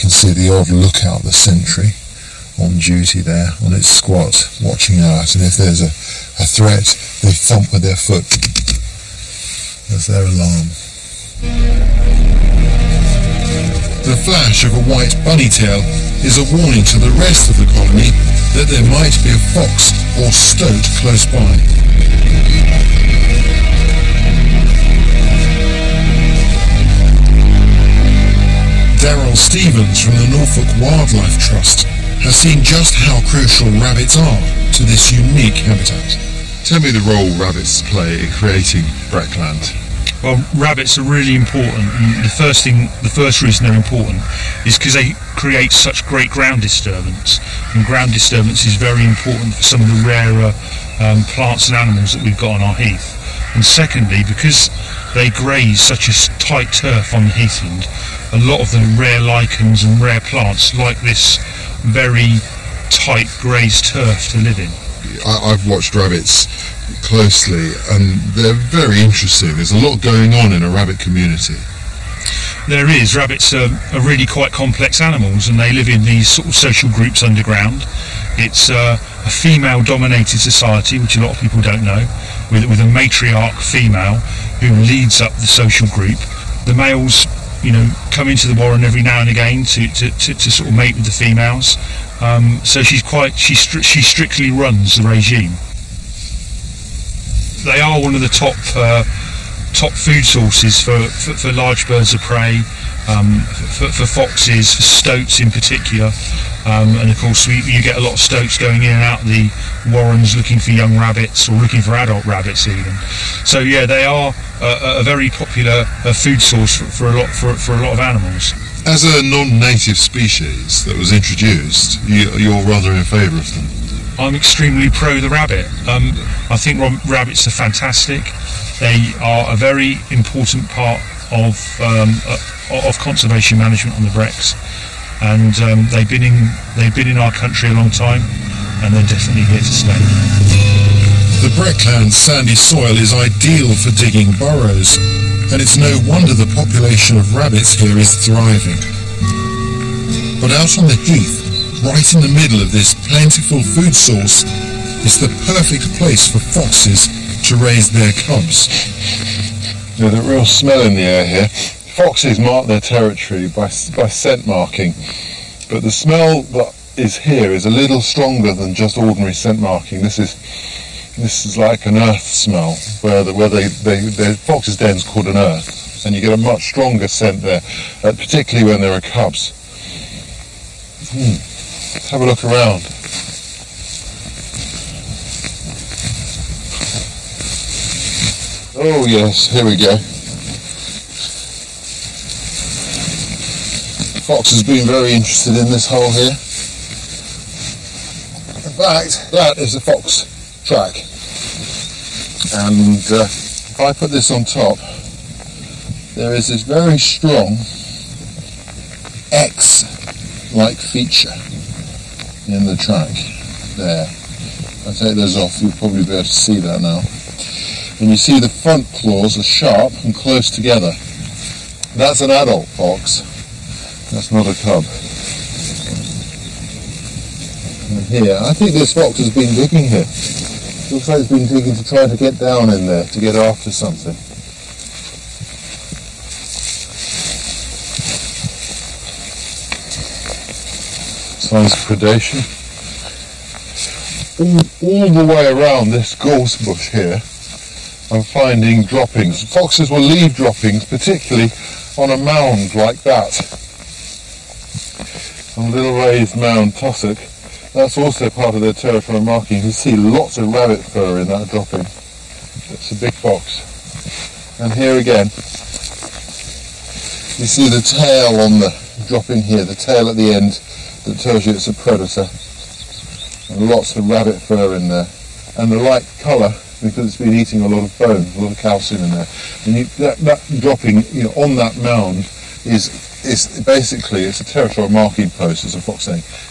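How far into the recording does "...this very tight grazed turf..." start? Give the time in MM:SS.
01:01.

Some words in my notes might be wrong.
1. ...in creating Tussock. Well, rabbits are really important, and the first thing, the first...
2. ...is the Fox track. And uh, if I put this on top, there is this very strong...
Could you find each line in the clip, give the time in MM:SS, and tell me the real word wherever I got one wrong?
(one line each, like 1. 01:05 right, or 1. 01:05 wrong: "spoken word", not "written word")
1. 00:38 wrong: "Breckland", not "Tussock"
2. 03:19 right.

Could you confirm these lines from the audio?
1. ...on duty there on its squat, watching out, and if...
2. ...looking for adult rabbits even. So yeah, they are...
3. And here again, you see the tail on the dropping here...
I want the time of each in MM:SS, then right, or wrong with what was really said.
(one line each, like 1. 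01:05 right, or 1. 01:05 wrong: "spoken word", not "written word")
1. 00:02 right
2. 01:51 right
3. 04:24 right.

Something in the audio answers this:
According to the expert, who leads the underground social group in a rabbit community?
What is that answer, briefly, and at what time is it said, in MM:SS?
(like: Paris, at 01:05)
a matriarch female, at 01:22.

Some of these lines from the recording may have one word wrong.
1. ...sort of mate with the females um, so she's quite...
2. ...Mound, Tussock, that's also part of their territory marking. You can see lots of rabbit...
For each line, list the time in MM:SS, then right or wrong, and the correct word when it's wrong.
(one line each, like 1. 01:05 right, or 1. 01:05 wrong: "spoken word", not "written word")
1. 01:30 right
2. 04:16 right.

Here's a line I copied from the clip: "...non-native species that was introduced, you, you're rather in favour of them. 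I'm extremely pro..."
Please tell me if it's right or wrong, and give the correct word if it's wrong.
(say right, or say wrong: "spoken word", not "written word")
right.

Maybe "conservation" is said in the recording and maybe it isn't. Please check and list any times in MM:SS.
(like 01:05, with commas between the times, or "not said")
02:12.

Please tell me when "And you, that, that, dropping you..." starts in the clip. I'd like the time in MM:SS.
04:39.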